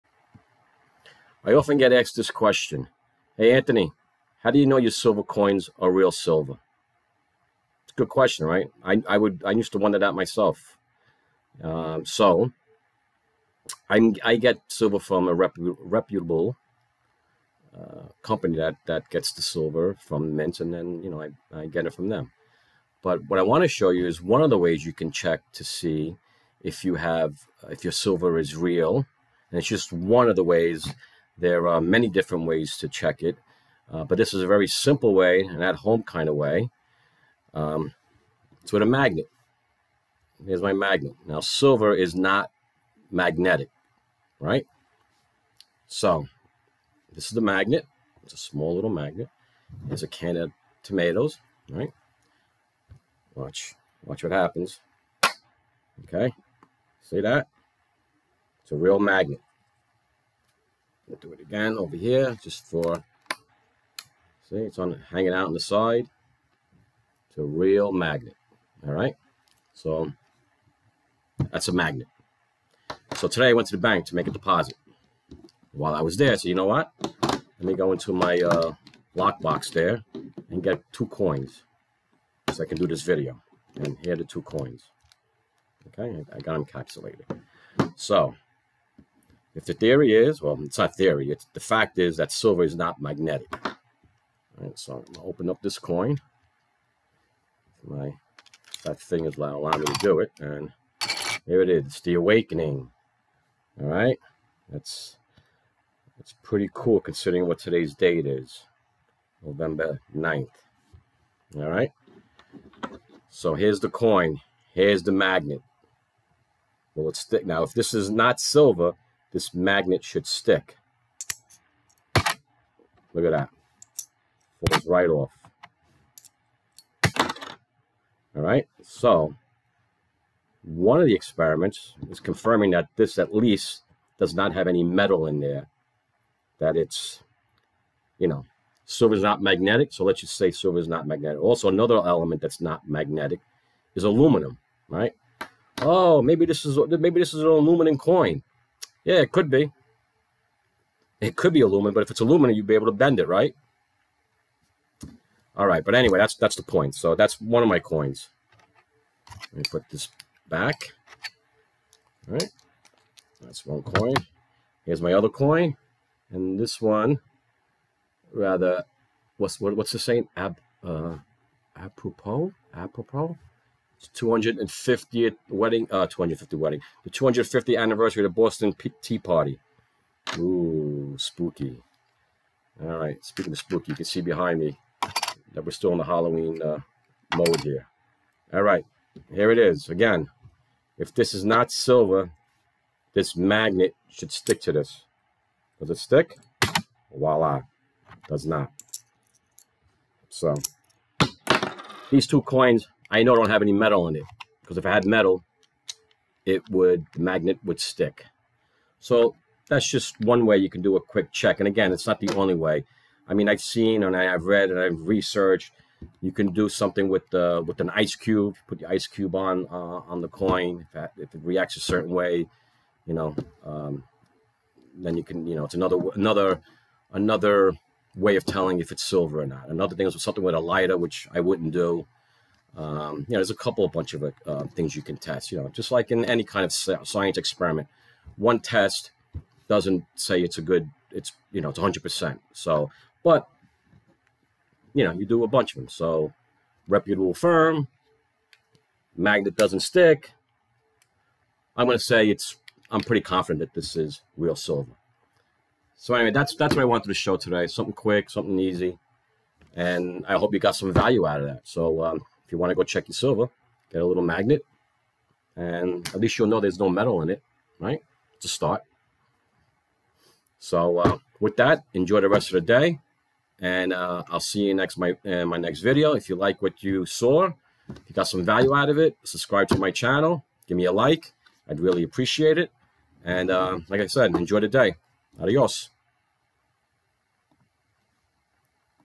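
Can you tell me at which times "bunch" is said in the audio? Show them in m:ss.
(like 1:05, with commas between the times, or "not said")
3:53, 4:05.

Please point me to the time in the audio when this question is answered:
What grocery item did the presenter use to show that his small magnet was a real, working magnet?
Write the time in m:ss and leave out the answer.
0:50.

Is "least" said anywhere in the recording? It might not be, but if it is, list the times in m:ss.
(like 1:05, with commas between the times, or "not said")
2:13, 4:26.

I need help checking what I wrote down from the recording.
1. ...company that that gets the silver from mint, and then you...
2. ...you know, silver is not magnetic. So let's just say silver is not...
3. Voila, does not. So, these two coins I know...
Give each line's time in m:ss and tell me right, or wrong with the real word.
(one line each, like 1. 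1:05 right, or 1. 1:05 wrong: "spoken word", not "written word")
1. 0:18 right
2. 2:18 right
3. 3:17 right.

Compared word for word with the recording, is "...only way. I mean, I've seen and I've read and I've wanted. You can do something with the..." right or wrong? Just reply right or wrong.
wrong.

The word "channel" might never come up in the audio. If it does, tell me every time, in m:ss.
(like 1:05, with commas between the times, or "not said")
4:39.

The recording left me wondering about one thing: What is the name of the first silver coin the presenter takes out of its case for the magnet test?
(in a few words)
The Awakening.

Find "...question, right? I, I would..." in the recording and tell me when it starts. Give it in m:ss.
0:08.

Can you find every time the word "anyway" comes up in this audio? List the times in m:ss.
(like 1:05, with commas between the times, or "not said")
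2:35, 4:16.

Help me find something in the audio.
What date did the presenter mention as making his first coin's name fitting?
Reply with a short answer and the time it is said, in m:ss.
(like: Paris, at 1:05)
November 9th, at 1:49.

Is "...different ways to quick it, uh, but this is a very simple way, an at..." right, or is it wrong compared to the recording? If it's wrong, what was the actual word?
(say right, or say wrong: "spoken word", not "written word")
wrong: "check", not "quick".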